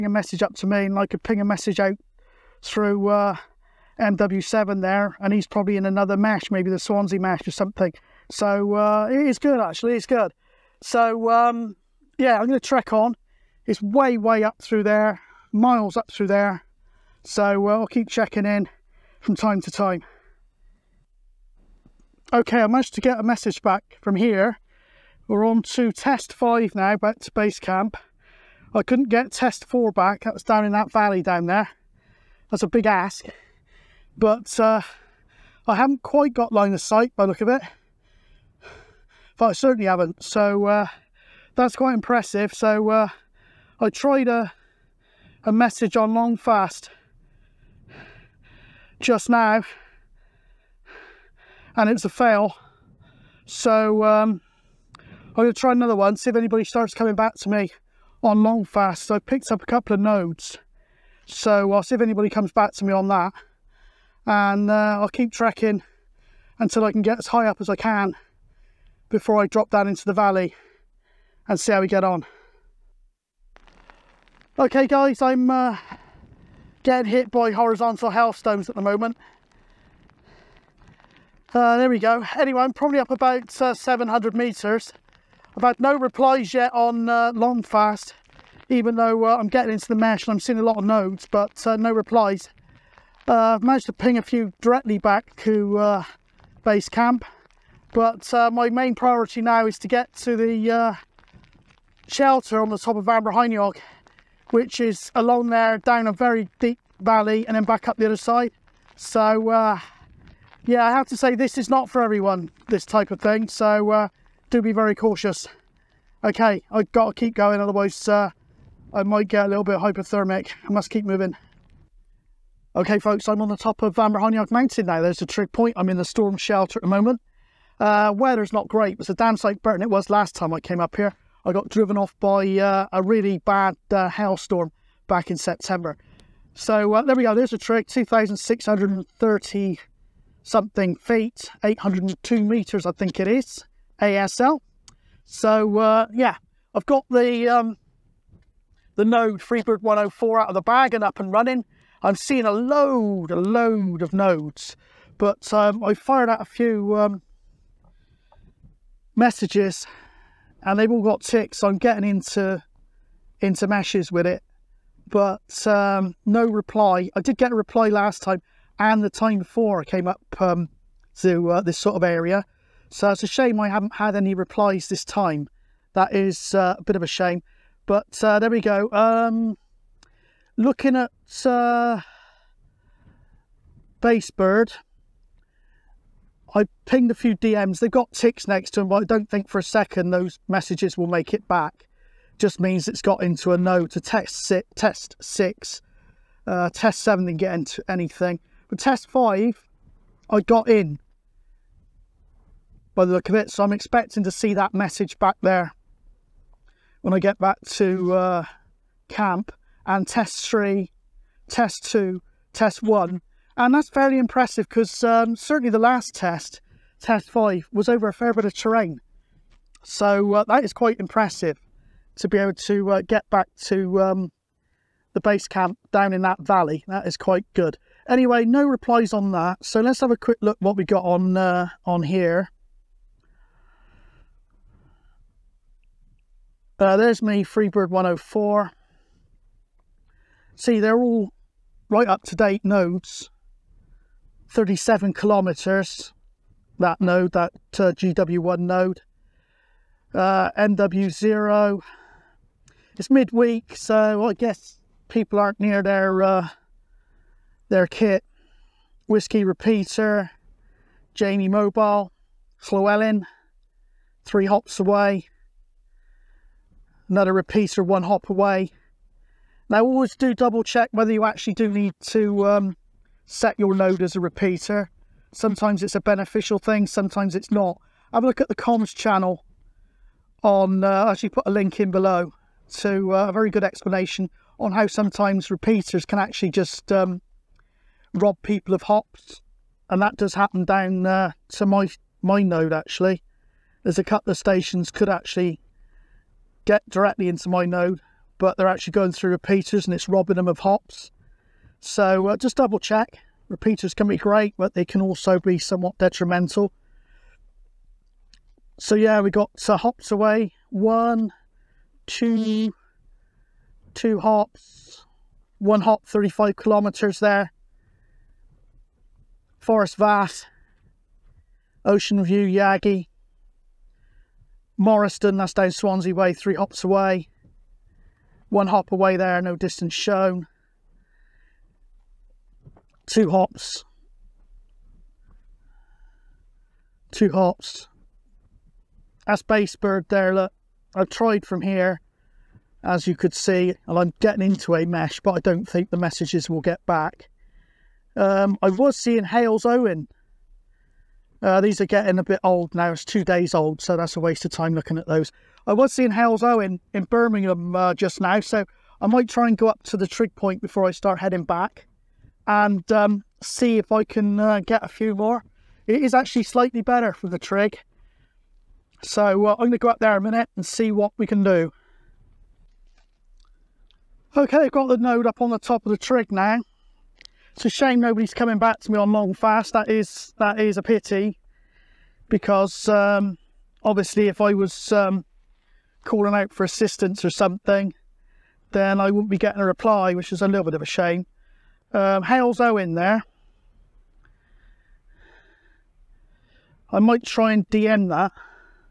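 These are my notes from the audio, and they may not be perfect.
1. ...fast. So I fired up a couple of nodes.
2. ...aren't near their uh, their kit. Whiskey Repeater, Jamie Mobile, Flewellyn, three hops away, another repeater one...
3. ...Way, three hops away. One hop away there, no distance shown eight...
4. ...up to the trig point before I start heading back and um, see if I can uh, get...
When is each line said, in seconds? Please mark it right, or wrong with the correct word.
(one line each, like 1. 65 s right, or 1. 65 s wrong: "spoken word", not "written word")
1. 58 s wrong: "picked", not "fired"
2. 255 s right
3. 326 s wrong: "two", not "eight"
4. 359 s right.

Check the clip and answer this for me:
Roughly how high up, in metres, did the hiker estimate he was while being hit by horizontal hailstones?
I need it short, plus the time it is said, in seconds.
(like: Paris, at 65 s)
700 metres, at 83 s.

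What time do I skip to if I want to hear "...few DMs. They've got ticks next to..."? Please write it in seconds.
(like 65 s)
187 s.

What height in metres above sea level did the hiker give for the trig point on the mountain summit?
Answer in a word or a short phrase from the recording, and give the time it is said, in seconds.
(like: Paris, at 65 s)
802 meters, at 141 s.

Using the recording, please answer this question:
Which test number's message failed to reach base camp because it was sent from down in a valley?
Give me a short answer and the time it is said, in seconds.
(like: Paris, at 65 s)
4, at 29 s.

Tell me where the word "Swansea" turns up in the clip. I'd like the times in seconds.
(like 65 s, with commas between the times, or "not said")
6 s, 325 s.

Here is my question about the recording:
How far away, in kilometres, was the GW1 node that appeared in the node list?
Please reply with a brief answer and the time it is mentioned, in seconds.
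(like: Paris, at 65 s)
37 kilometers, at 244 s.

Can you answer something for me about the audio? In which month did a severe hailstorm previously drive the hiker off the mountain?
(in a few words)
September.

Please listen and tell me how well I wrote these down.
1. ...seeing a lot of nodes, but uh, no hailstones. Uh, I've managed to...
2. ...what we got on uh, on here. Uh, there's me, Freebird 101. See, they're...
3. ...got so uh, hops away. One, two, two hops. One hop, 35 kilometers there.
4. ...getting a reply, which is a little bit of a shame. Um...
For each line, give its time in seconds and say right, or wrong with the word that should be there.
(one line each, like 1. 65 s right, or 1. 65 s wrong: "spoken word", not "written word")
1. 90 s wrong: "replies", not "hailstones"
2. 230 s wrong: "104", not "101"
3. 309 s right
4. 389 s right.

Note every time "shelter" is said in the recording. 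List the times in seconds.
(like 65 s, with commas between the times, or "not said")
102 s, 126 s.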